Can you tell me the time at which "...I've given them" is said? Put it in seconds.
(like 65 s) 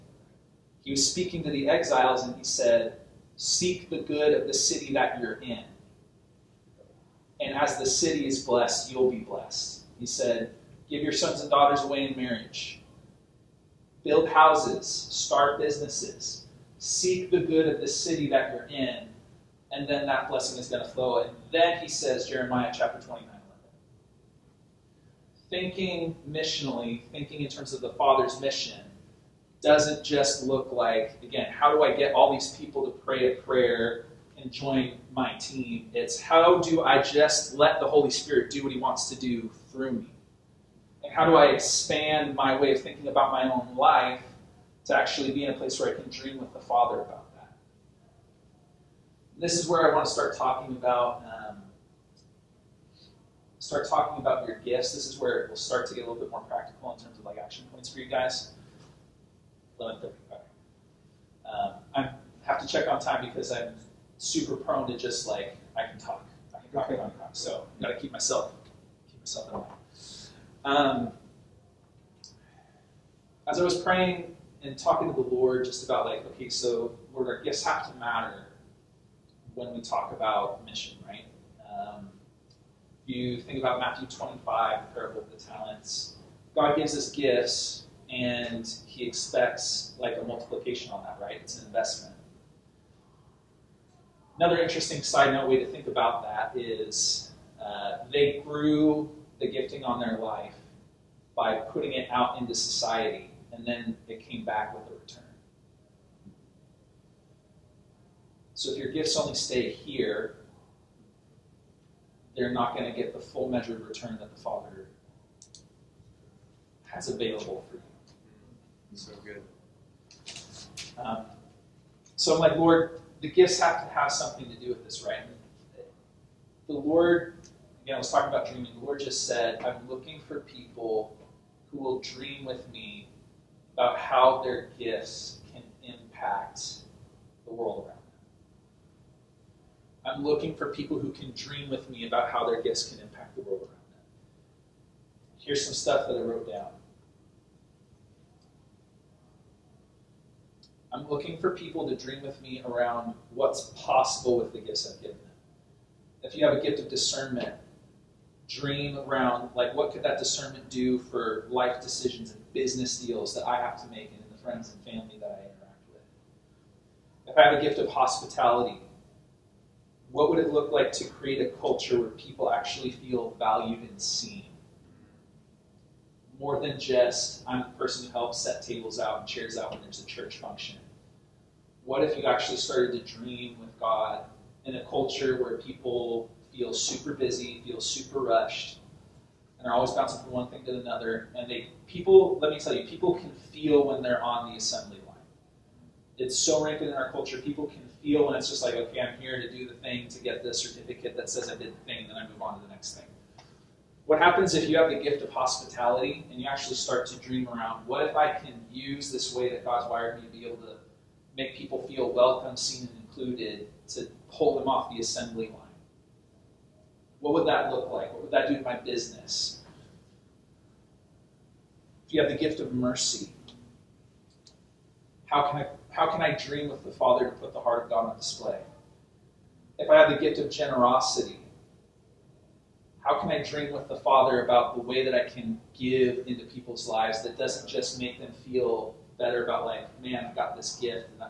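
154 s.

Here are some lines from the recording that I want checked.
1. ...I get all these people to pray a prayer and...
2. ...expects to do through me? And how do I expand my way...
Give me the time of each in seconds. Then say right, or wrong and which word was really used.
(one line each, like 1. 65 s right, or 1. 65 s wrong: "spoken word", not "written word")
1. 31 s right
2. 38 s wrong: "wants", not "expects".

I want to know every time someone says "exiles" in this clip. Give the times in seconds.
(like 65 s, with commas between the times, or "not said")
1 s.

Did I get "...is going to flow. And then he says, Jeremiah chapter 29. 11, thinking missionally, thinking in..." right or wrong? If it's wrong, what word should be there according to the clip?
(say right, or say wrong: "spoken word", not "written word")
right.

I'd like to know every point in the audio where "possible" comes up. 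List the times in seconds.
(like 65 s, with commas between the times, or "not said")
153 s.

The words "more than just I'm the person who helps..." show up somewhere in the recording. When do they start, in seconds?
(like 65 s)
176 s.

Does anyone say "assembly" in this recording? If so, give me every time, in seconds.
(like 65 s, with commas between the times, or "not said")
194 s, 214 s.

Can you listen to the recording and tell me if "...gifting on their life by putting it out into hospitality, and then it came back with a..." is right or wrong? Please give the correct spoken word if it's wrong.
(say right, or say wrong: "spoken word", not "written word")
wrong: "society", not "hospitality".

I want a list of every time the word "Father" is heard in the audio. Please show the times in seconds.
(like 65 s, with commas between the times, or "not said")
27 s, 46 s, 114 s, 226 s, 233 s.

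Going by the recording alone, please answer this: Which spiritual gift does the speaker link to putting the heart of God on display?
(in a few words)
mercy.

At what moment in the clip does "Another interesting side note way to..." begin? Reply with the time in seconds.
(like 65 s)
94 s.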